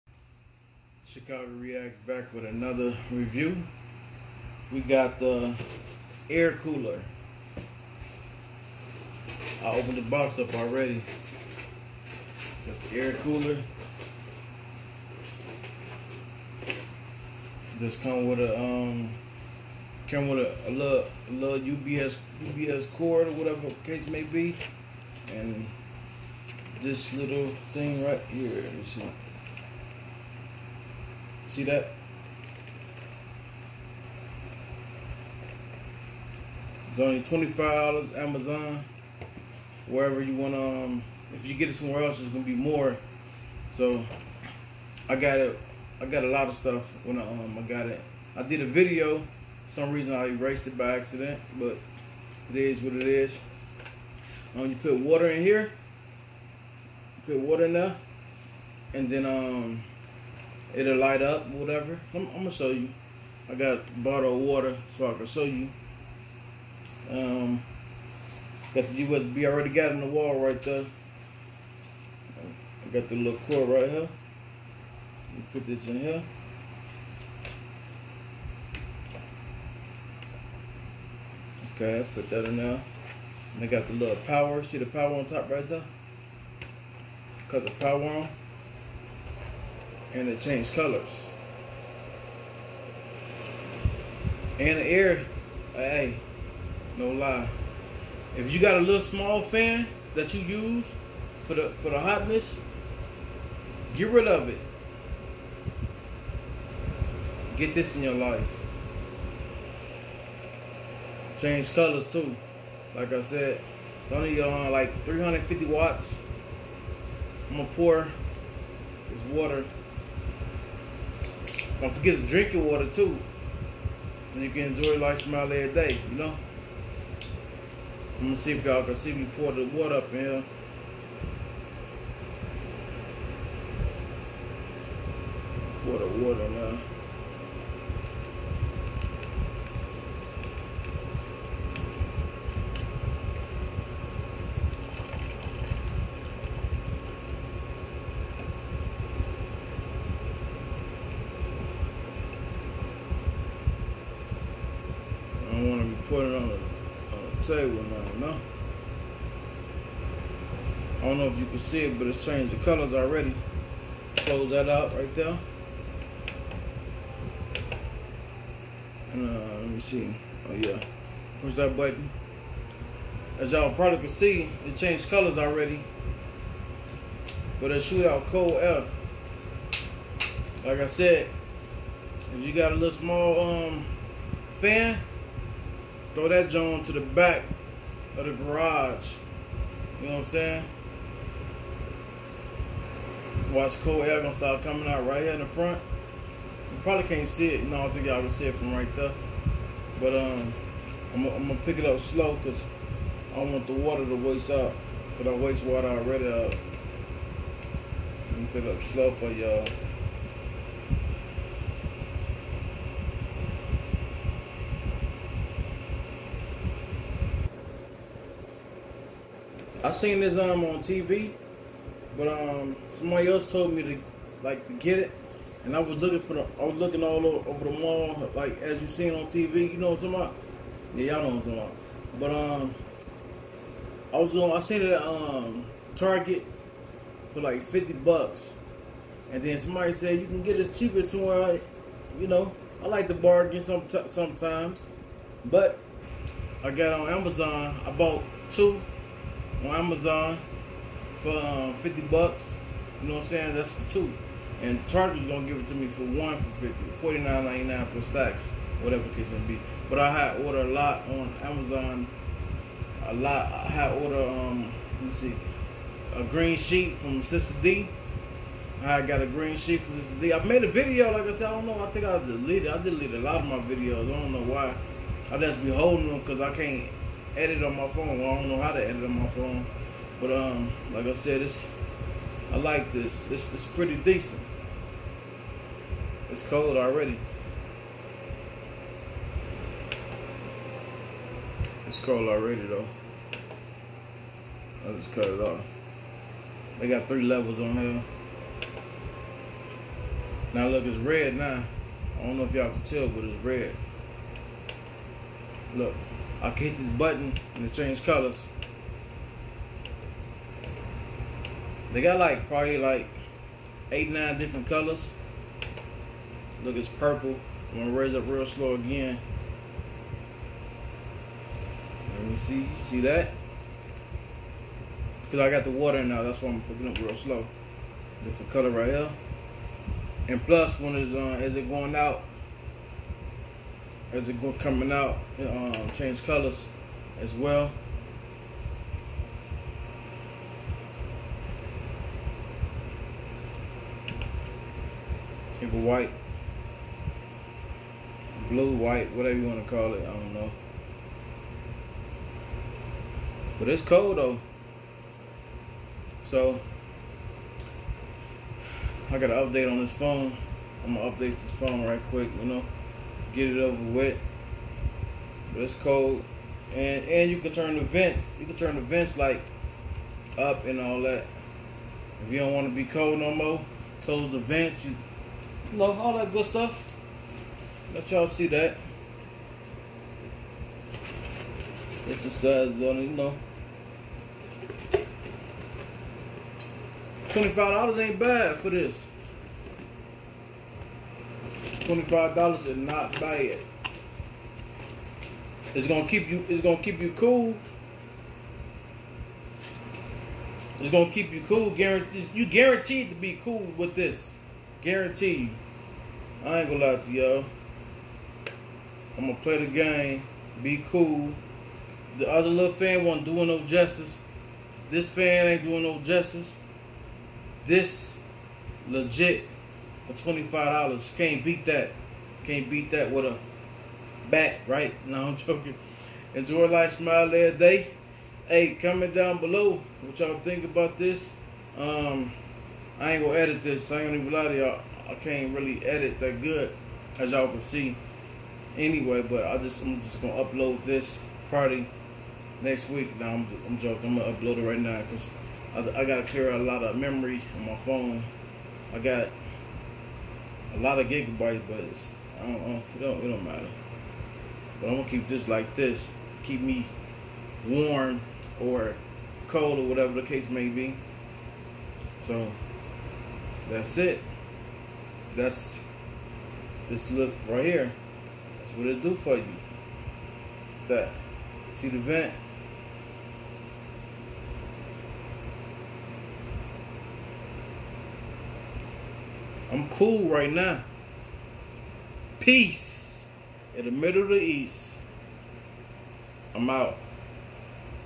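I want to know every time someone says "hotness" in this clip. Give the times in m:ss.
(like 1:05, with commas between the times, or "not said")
1:41.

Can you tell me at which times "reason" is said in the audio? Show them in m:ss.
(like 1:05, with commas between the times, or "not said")
0:49.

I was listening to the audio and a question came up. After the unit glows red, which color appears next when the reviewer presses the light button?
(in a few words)
Purple.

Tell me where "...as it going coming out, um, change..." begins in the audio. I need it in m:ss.
5:34.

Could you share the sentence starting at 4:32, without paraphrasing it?
I deleted a lot of my videos.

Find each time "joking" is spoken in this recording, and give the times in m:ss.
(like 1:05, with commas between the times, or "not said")
7:05, 7:23.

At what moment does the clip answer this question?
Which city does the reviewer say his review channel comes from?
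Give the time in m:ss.
0:01.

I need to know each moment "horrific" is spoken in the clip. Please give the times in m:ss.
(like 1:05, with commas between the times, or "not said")
not said.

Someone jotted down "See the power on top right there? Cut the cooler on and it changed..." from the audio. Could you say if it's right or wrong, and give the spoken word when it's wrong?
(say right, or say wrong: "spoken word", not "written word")
wrong: "power", not "cooler".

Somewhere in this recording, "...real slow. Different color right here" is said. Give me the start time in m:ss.
5:26.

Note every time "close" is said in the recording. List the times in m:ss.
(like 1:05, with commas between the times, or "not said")
2:44, 6:14.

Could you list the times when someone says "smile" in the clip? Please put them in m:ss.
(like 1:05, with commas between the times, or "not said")
2:05, 7:06.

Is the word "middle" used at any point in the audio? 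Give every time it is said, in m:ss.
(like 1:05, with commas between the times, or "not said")
8:03.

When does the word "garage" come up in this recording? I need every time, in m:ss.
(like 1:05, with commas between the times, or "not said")
3:08.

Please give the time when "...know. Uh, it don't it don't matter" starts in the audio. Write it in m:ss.
7:32.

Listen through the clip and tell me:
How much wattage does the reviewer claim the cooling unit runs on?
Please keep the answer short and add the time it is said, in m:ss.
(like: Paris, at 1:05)
350 watts, at 1:55.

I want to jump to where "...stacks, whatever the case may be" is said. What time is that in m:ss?
4:18.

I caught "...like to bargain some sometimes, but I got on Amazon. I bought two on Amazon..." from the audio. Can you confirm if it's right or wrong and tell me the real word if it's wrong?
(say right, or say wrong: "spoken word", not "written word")
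right.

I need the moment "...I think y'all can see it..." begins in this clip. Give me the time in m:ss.
3:17.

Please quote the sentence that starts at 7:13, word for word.
I ain't even lie to y'all.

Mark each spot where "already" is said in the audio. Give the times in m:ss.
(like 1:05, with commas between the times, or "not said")
0:10, 1:09, 2:42, 2:55, 3:25, 4:46, 4:52.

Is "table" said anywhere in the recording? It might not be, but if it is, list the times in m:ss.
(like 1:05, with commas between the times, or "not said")
2:37.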